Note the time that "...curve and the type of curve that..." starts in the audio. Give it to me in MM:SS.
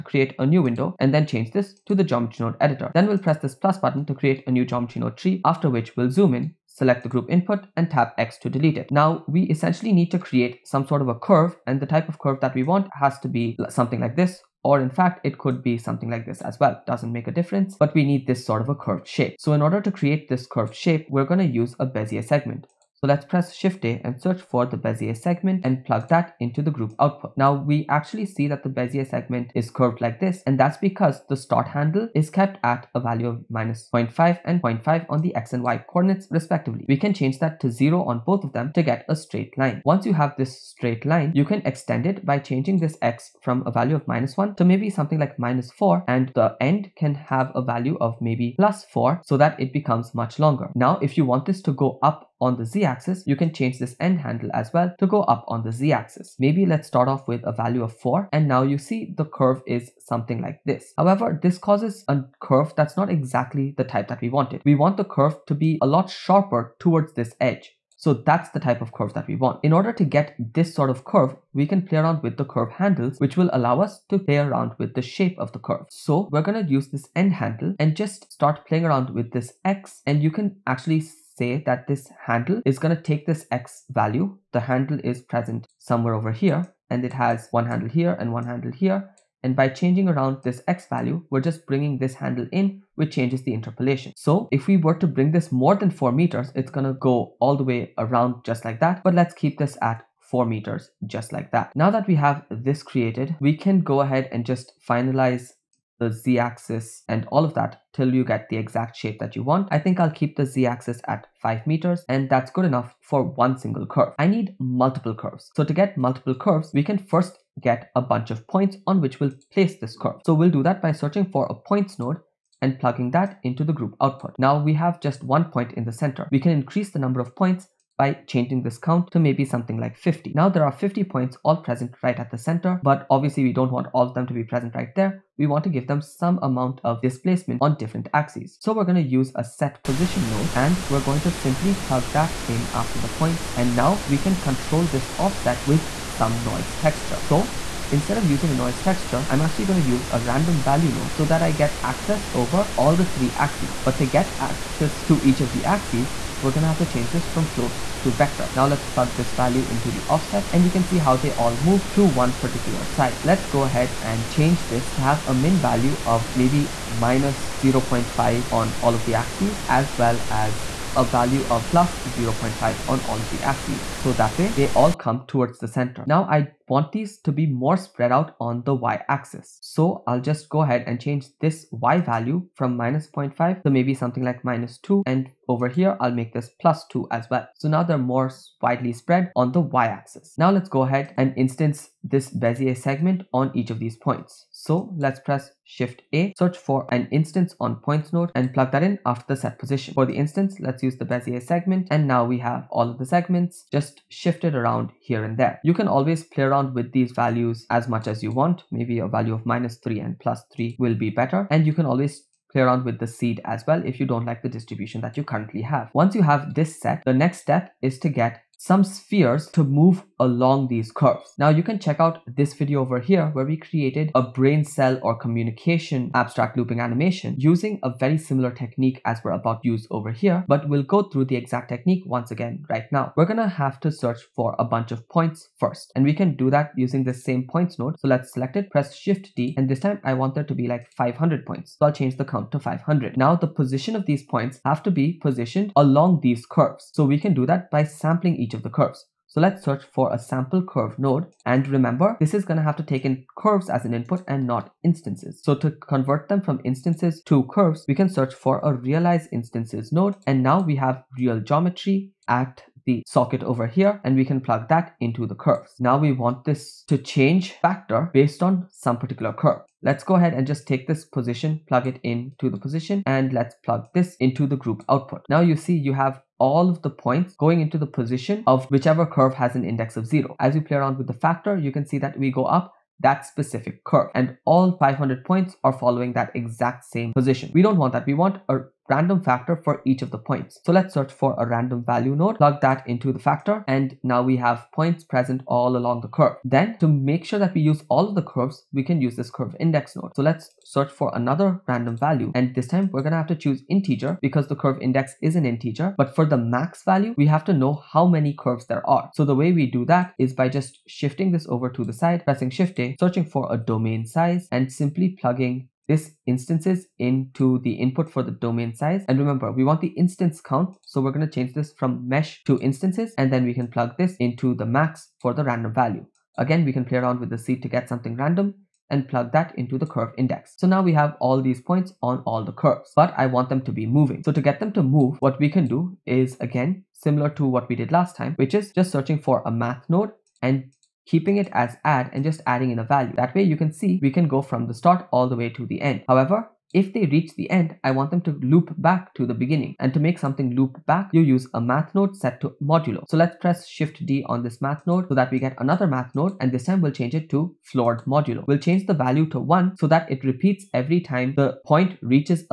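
00:11.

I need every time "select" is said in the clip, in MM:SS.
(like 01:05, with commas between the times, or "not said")
00:06, 03:58.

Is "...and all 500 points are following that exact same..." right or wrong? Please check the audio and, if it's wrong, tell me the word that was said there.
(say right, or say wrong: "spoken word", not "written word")
right.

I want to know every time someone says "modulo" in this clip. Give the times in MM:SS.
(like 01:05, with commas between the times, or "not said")
05:52, 05:58.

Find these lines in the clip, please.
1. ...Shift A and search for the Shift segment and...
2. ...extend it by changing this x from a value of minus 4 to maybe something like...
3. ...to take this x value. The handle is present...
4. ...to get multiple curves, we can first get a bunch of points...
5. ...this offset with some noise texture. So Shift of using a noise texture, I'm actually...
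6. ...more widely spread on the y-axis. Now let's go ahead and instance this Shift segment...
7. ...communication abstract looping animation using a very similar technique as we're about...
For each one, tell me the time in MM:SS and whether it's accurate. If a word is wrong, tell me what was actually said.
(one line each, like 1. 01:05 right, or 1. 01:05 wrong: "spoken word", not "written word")
1. 00:23 wrong: "Bezier", not "Shift"
2. 00:41 wrong: "1", not "4"
3. 01:22 right
4. 01:55 right
5. 02:24 wrong: "Instead", not "Shift"
6. 03:07 wrong: "Bezier", not "Shift"
7. 03:45 right.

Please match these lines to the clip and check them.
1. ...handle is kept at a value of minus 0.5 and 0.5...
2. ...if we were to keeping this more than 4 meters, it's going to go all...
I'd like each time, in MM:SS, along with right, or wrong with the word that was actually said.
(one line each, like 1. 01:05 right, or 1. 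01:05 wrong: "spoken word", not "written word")
1. 00:31 right
2. 01:34 wrong: "bring", not "keeping".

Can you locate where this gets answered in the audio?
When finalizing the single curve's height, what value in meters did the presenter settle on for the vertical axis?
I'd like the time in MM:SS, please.
01:51.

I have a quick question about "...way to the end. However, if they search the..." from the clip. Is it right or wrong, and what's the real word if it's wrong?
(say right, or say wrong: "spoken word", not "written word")
wrong: "reach", not "search".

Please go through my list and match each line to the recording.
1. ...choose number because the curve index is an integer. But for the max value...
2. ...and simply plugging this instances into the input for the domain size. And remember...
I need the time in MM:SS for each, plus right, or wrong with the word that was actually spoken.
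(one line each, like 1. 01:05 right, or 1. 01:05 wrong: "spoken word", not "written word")
1. 05:03 wrong: "integer", not "number"
2. 05:14 right.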